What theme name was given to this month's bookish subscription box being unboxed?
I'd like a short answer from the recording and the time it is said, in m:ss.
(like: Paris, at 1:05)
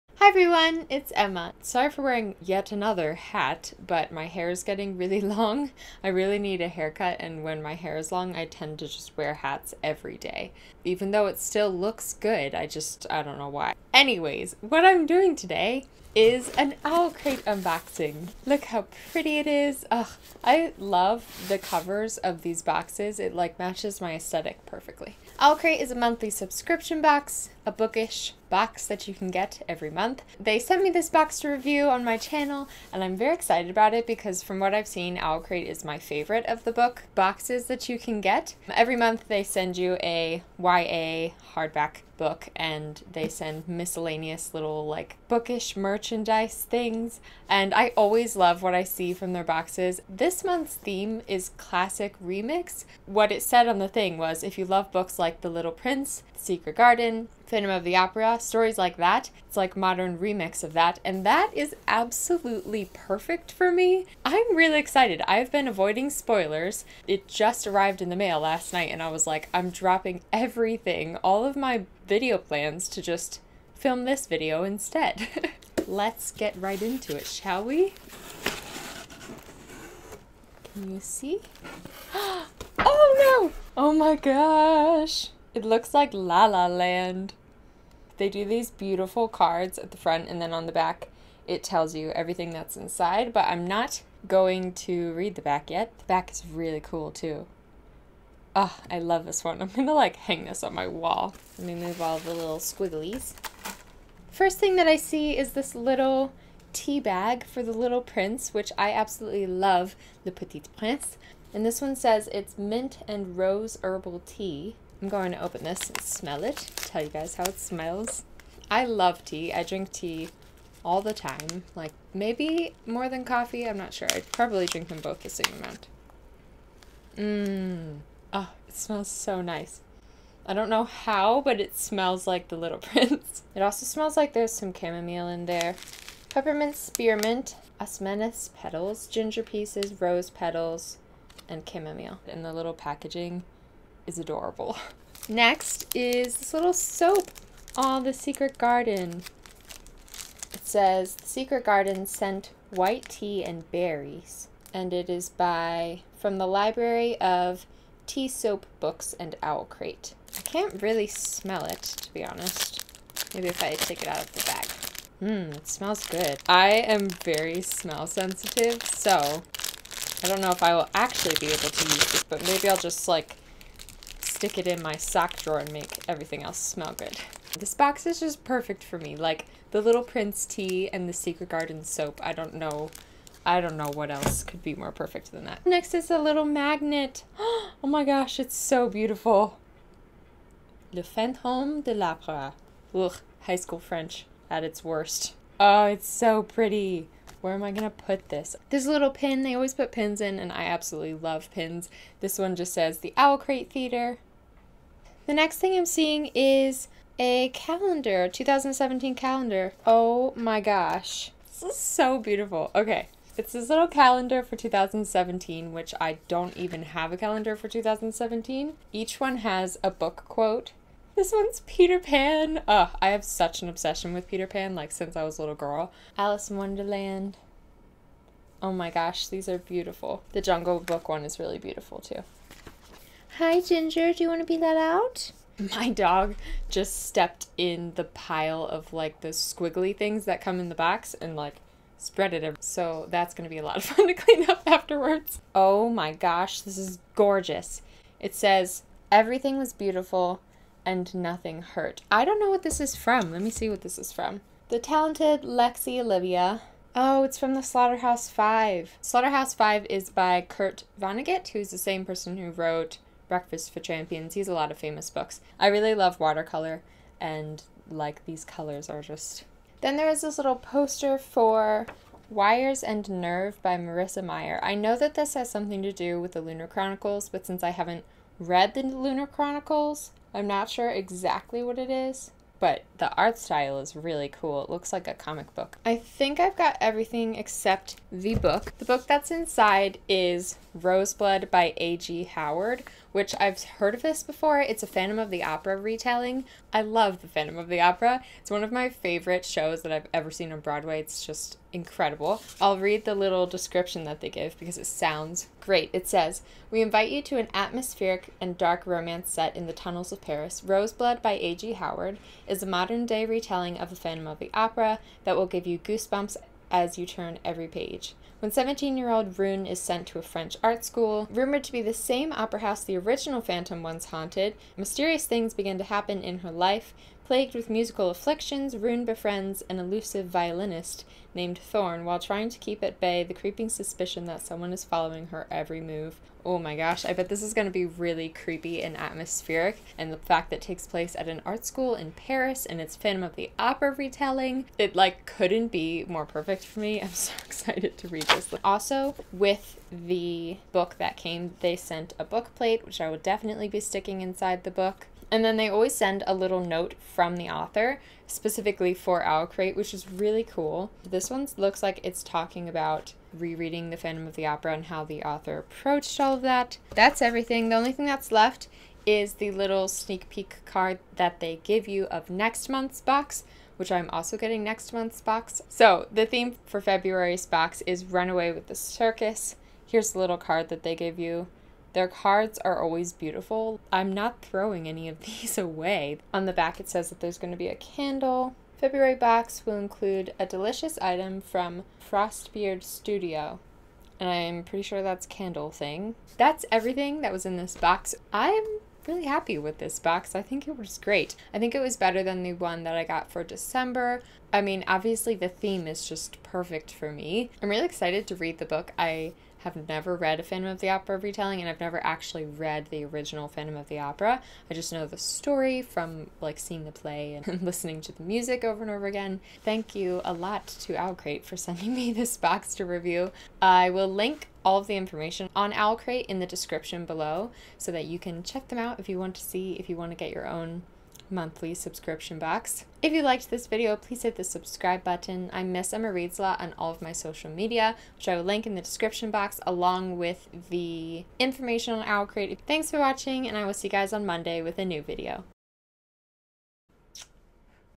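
Classic remix, at 0:51.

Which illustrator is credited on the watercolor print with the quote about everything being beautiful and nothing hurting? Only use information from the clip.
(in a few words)
Lexi Olivia.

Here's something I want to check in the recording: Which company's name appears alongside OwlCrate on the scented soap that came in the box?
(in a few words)
Tea Soap Books.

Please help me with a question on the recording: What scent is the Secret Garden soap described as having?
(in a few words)
White tea and berries.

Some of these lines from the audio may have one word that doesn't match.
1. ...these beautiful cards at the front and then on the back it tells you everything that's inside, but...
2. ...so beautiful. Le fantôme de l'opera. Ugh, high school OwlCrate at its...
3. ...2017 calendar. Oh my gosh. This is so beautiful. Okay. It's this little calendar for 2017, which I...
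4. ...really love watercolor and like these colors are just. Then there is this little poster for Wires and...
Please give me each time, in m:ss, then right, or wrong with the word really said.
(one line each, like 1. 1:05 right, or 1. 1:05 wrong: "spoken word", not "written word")
1. 1:28 right
2. 3:08 wrong: "French", not "OwlCrate"
3. 3:28 right
4. 4:25 right.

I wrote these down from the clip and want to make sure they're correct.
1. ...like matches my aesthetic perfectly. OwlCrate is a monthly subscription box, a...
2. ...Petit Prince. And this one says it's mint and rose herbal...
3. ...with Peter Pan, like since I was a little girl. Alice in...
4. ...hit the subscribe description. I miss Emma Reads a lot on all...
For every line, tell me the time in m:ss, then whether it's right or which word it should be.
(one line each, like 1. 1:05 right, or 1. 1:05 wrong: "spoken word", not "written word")
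1. 0:23 right
2. 1:50 right
3. 3:44 right
4. 7:14 wrong: "button", not "description".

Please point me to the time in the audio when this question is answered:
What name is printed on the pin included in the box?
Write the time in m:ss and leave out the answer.
3:22.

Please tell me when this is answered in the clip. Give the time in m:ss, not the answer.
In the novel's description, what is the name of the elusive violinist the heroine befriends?
5:31.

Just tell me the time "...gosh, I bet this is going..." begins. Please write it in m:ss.
5:36.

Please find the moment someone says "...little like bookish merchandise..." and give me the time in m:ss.
0:44.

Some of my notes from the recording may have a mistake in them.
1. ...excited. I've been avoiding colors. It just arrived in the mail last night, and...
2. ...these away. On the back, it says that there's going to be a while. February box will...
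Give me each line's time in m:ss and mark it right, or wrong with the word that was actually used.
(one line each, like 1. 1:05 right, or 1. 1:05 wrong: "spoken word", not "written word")
1. 1:04 wrong: "spoilers", not "colors"
2. 6:25 wrong: "candle", not "while".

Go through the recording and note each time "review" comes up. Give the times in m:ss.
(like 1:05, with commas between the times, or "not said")
0:31, 7:02.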